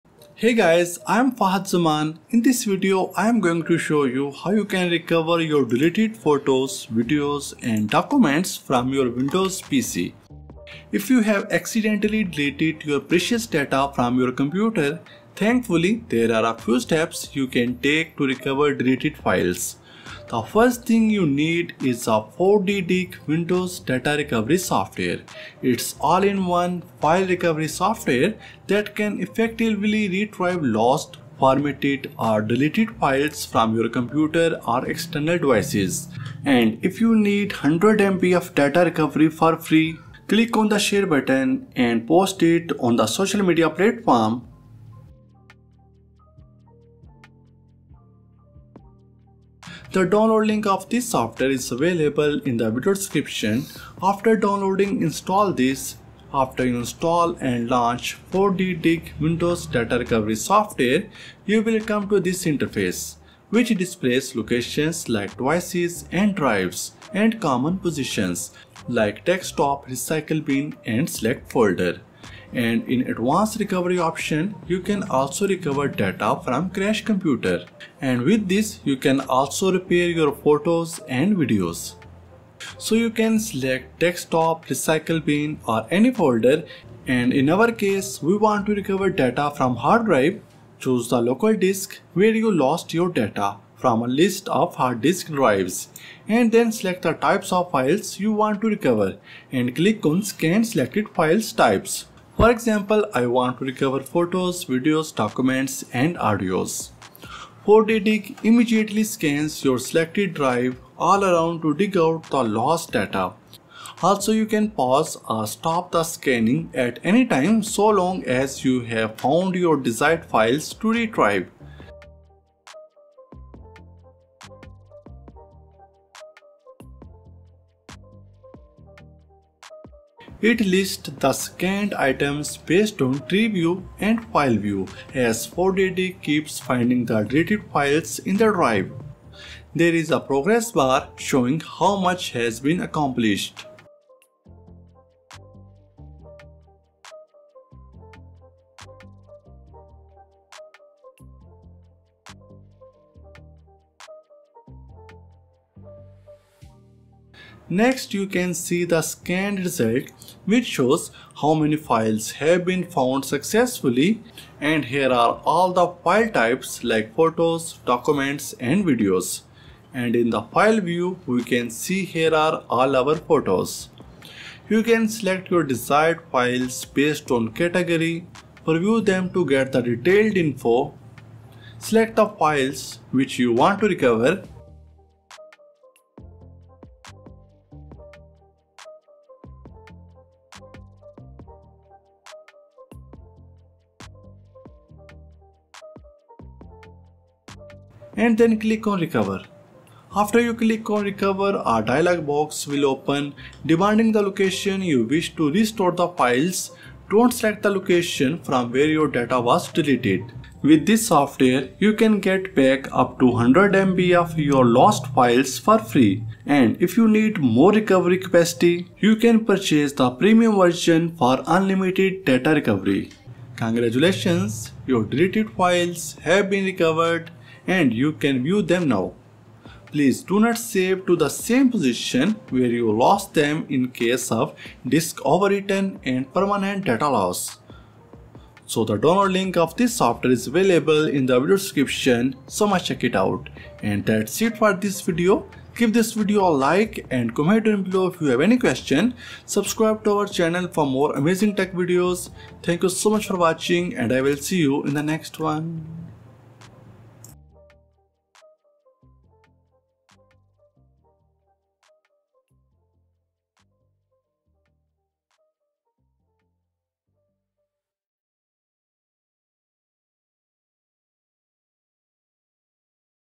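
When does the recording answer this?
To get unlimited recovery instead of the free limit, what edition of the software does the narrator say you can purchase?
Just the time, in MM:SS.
03:40.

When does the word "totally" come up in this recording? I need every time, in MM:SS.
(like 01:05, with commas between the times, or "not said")
not said.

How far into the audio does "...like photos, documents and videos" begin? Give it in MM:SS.
02:46.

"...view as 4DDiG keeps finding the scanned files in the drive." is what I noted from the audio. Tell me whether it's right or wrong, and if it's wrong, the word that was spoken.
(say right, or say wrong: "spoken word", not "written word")
wrong: "deleted", not "scanned".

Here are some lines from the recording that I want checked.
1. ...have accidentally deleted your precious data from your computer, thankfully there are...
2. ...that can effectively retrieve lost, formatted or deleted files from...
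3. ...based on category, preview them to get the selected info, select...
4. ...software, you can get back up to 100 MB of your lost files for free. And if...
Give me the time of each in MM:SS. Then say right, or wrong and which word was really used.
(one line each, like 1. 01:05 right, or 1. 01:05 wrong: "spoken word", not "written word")
1. 00:11 right
2. 00:28 right
3. 02:56 wrong: "detailed", not "selected"
4. 03:31 right.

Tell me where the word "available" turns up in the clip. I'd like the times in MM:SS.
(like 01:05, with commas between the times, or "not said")
00:51, 04:00.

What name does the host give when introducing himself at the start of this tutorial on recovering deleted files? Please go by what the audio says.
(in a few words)
Fahed Zaman.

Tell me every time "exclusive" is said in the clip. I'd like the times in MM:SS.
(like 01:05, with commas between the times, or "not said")
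not said.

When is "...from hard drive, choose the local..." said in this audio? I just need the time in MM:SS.
01:29.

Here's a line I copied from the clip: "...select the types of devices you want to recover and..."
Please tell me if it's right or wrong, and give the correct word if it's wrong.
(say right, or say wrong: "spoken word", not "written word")
wrong: "files", not "devices".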